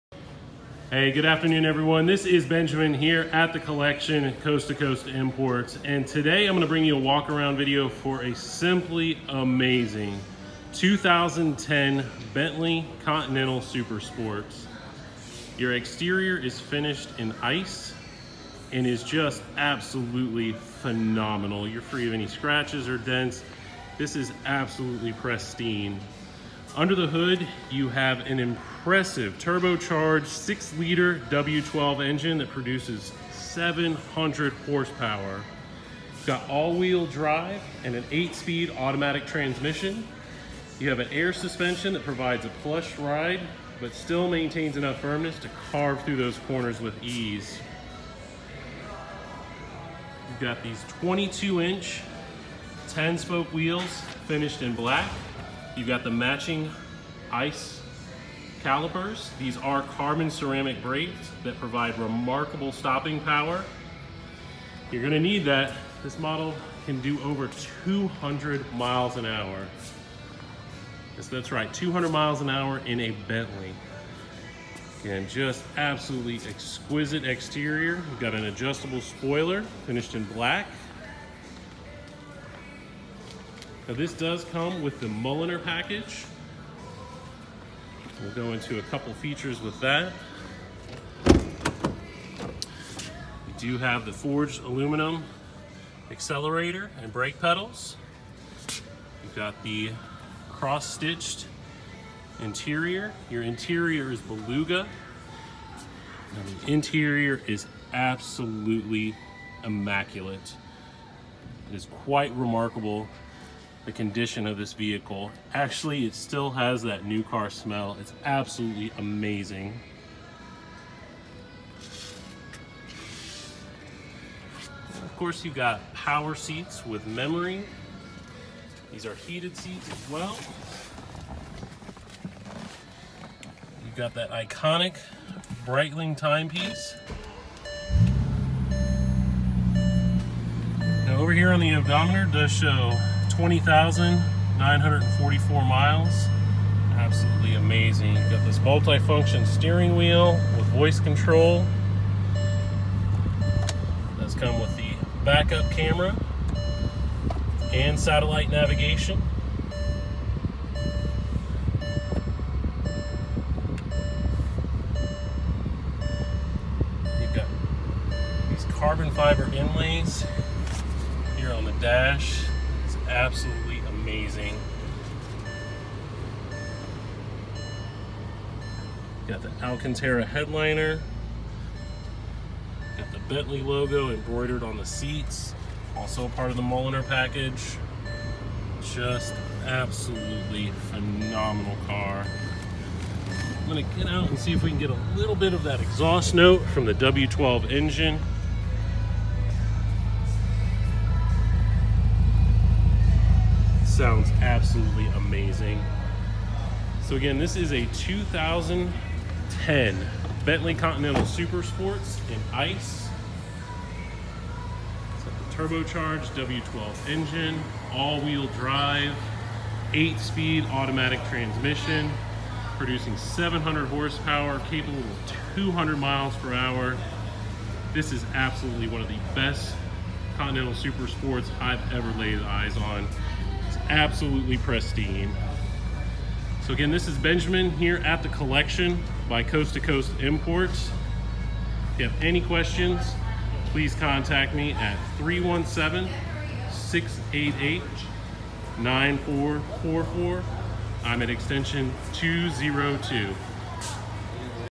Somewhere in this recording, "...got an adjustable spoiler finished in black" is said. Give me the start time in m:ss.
1:18.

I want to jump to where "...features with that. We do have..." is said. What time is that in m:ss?
1:29.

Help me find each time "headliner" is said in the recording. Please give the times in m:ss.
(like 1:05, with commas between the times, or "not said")
3:00.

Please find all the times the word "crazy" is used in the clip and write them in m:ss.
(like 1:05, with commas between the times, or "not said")
not said.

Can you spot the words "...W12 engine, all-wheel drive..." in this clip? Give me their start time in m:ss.
3:36.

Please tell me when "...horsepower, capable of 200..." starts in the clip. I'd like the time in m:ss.
3:43.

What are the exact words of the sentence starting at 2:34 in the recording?
That's come with the backup camera and satellite navigation.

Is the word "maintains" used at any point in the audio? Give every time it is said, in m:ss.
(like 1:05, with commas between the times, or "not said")
0:44.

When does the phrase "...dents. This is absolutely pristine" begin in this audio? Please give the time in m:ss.
0:22.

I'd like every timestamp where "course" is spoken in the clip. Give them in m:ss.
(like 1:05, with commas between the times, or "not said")
2:05.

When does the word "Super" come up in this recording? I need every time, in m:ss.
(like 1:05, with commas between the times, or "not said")
0:13, 3:31, 3:50.